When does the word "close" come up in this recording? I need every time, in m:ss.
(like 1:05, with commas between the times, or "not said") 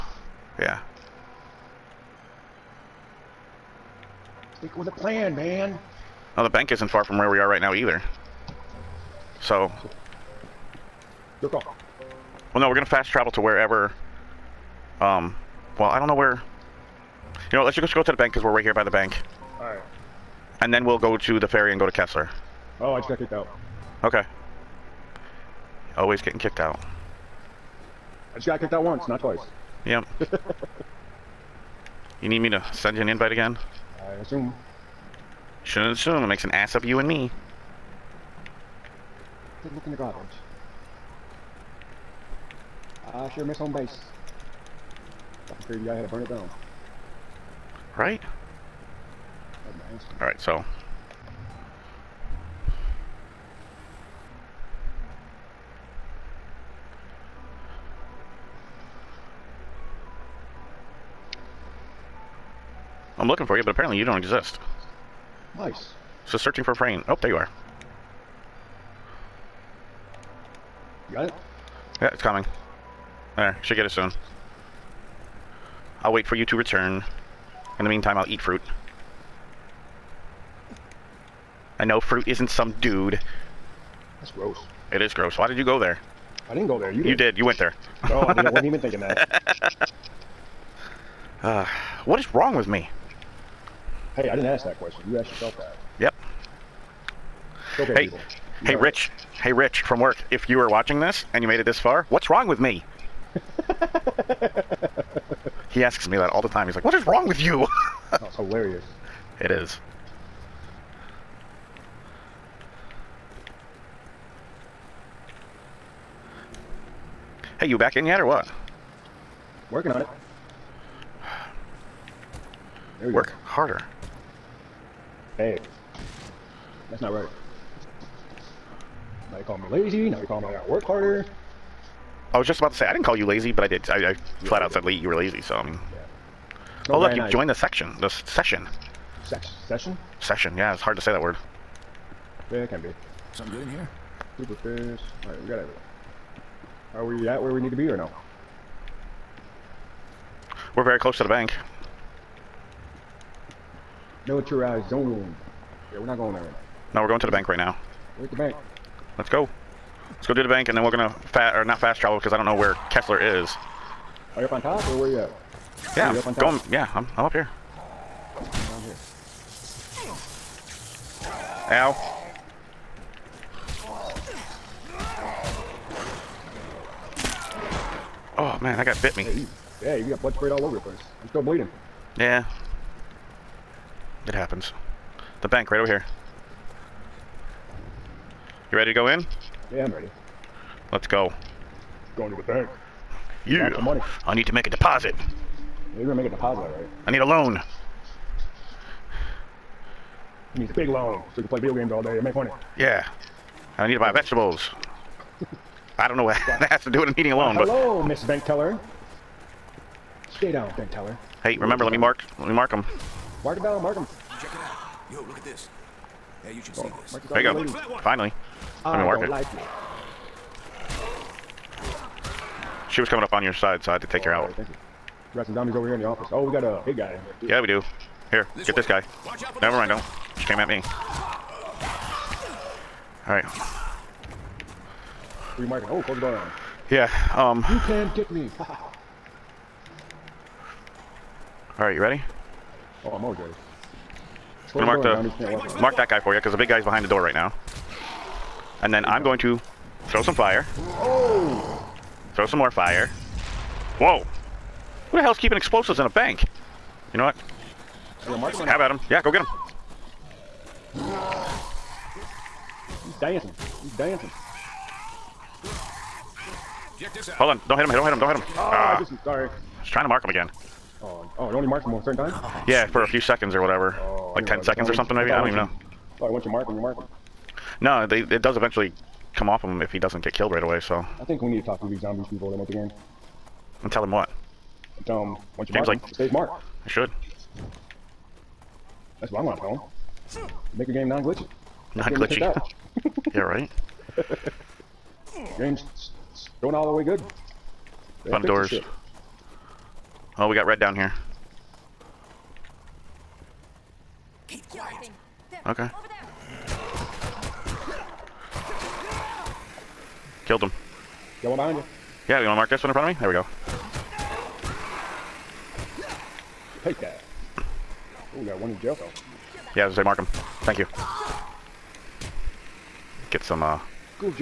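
2:30, 3:56.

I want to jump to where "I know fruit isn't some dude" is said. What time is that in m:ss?
1:21.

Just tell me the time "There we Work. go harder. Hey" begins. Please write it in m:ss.
2:02.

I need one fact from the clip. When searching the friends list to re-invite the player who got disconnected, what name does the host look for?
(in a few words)
Frayne.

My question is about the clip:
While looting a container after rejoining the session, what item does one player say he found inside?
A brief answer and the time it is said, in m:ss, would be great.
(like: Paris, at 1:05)
Super fish, at 2:24.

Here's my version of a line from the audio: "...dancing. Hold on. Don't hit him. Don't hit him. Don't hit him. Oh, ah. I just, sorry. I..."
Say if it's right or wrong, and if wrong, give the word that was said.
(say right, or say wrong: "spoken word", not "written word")
right.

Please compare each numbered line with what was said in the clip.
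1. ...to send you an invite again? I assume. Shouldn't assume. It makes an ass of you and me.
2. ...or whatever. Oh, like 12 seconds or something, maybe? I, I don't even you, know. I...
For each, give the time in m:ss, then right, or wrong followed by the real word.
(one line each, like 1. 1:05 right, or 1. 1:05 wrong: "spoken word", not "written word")
1. 0:32 right
2. 4:33 wrong: "10", not "12".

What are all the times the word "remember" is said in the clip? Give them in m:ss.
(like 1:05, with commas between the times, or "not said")
3:31.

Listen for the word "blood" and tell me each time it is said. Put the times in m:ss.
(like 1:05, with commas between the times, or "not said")
3:00.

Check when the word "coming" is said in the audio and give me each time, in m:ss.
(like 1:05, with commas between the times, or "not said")
1:12, 3:43.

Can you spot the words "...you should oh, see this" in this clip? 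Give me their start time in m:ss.
3:36.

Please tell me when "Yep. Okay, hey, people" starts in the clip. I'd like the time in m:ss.
1:35.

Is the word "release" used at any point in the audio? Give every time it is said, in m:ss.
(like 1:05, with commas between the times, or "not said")
not said.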